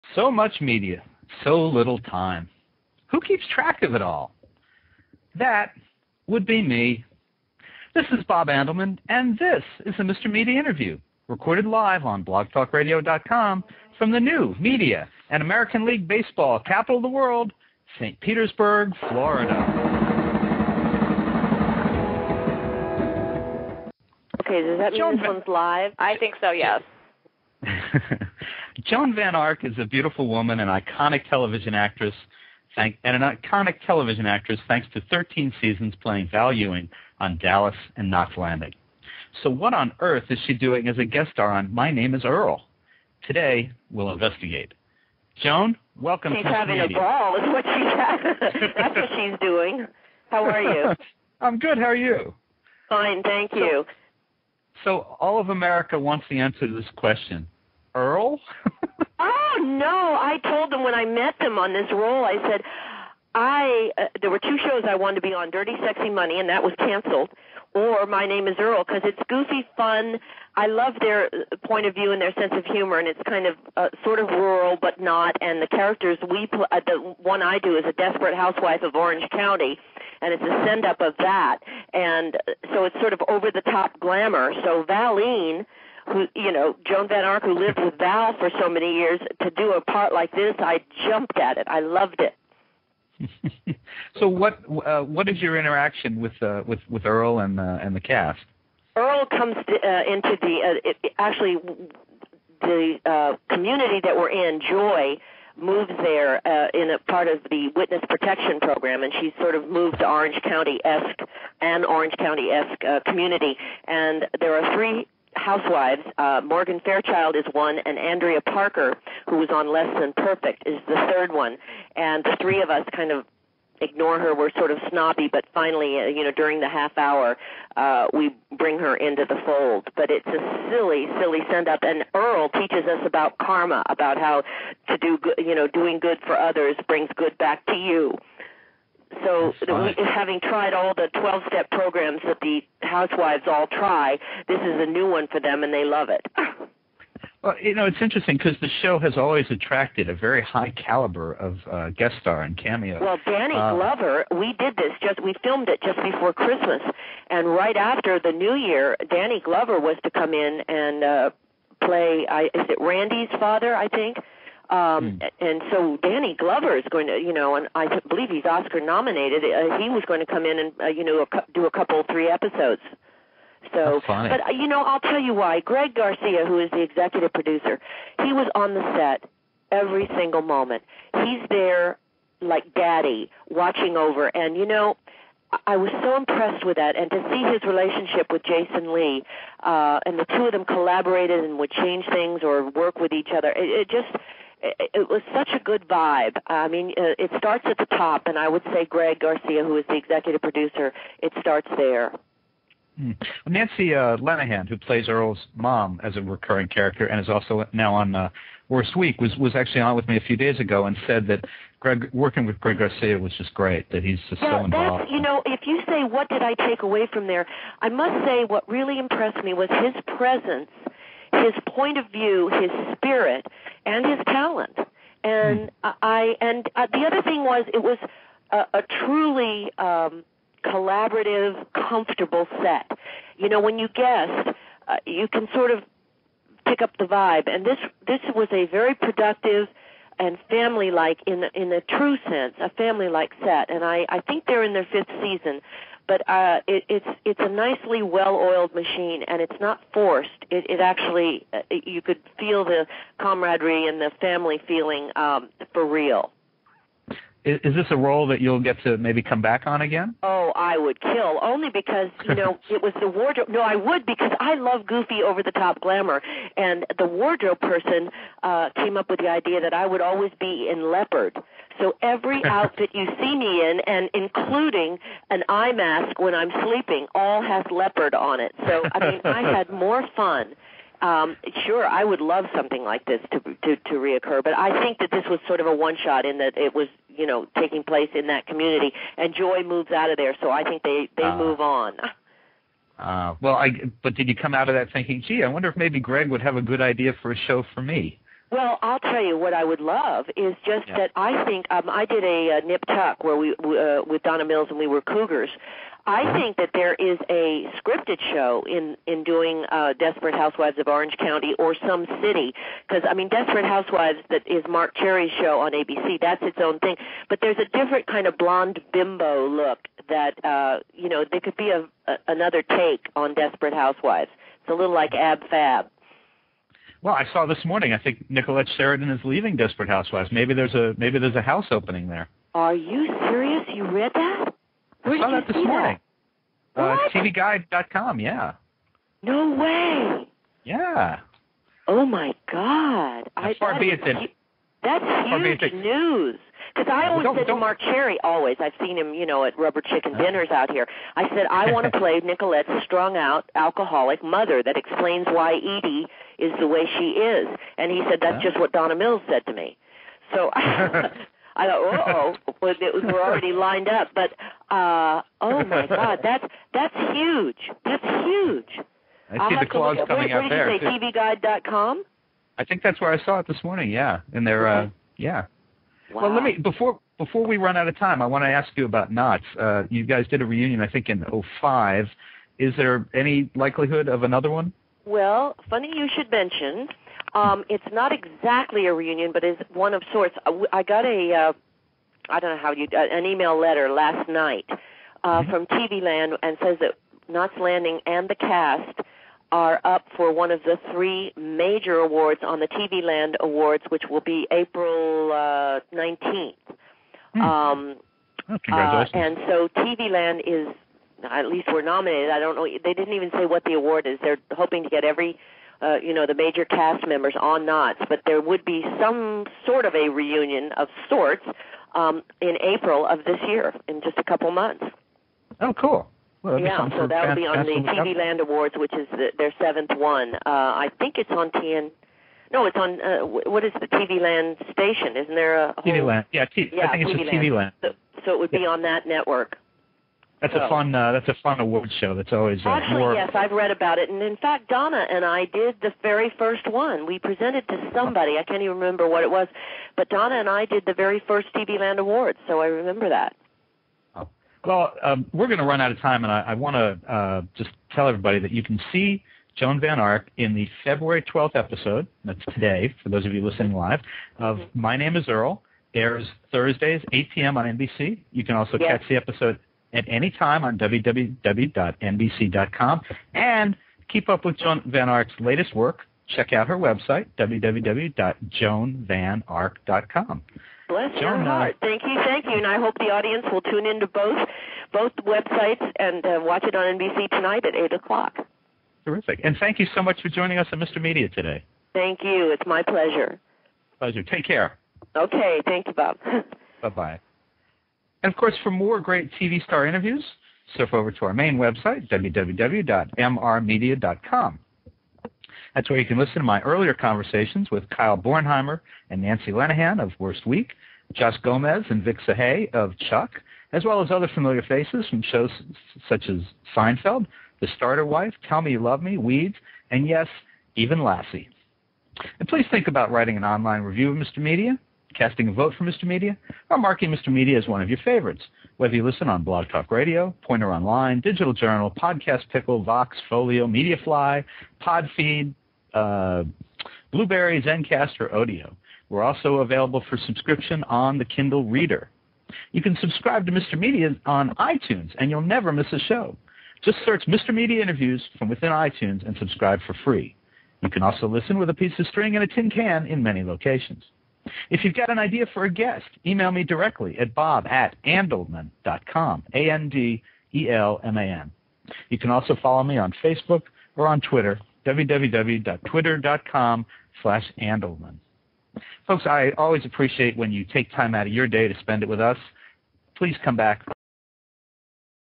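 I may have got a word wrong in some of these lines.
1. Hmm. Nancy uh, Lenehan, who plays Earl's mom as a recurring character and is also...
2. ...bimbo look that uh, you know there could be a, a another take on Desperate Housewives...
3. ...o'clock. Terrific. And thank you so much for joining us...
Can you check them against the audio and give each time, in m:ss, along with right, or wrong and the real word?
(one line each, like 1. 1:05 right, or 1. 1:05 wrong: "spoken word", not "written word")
1. 3:22 right
2. 5:18 right
3. 8:07 right.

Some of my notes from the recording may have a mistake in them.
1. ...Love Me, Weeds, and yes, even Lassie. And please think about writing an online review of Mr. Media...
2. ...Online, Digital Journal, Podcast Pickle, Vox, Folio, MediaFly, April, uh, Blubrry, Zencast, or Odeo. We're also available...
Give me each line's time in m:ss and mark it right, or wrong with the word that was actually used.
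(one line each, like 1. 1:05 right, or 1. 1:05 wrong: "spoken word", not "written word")
1. 8:38 right
2. 8:50 wrong: "Podfeed", not "April".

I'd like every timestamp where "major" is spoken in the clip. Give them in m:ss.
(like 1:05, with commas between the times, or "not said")
6:41, 6:56.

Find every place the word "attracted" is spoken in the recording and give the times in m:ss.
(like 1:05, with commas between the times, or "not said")
2:29.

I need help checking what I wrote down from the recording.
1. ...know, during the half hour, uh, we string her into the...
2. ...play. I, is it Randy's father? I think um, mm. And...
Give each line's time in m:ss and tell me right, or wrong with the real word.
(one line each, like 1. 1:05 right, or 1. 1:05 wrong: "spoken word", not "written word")
1. 2:06 wrong: "bring", not "string"
2. 2:41 right.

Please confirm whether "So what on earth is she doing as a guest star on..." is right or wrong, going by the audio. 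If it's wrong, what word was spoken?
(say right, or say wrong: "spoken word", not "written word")
right.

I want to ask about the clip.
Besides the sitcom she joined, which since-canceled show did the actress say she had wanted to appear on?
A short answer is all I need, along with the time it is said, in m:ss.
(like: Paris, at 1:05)
Dirty Sexy Money, at 1:05.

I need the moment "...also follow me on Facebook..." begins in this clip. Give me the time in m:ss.
9:22.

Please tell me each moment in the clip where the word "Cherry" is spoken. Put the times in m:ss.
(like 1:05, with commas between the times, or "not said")
5:14, 5:47.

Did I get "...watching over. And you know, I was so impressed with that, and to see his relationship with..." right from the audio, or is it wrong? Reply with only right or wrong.
right.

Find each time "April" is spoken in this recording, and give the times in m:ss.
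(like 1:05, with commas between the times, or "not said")
6:44, 7:02.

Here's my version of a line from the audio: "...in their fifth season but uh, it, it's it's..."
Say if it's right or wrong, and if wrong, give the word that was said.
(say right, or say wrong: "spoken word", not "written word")
right.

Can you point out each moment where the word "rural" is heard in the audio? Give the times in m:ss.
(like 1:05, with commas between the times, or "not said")
1:14.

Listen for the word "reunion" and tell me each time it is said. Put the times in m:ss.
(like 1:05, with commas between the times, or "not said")
6:20, 6:28, 7:00.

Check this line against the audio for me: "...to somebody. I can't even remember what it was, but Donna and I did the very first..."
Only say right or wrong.
right.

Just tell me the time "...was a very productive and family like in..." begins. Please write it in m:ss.
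3:58.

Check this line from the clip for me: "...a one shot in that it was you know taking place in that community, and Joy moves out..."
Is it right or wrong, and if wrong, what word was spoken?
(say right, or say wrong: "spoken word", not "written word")
right.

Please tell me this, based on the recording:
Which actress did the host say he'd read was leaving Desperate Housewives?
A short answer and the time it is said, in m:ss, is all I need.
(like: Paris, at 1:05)
Nicolette Sheridan, at 5:28.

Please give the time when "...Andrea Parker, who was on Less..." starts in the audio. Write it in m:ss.
1:57.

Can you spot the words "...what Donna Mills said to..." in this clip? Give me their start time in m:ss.
5:58.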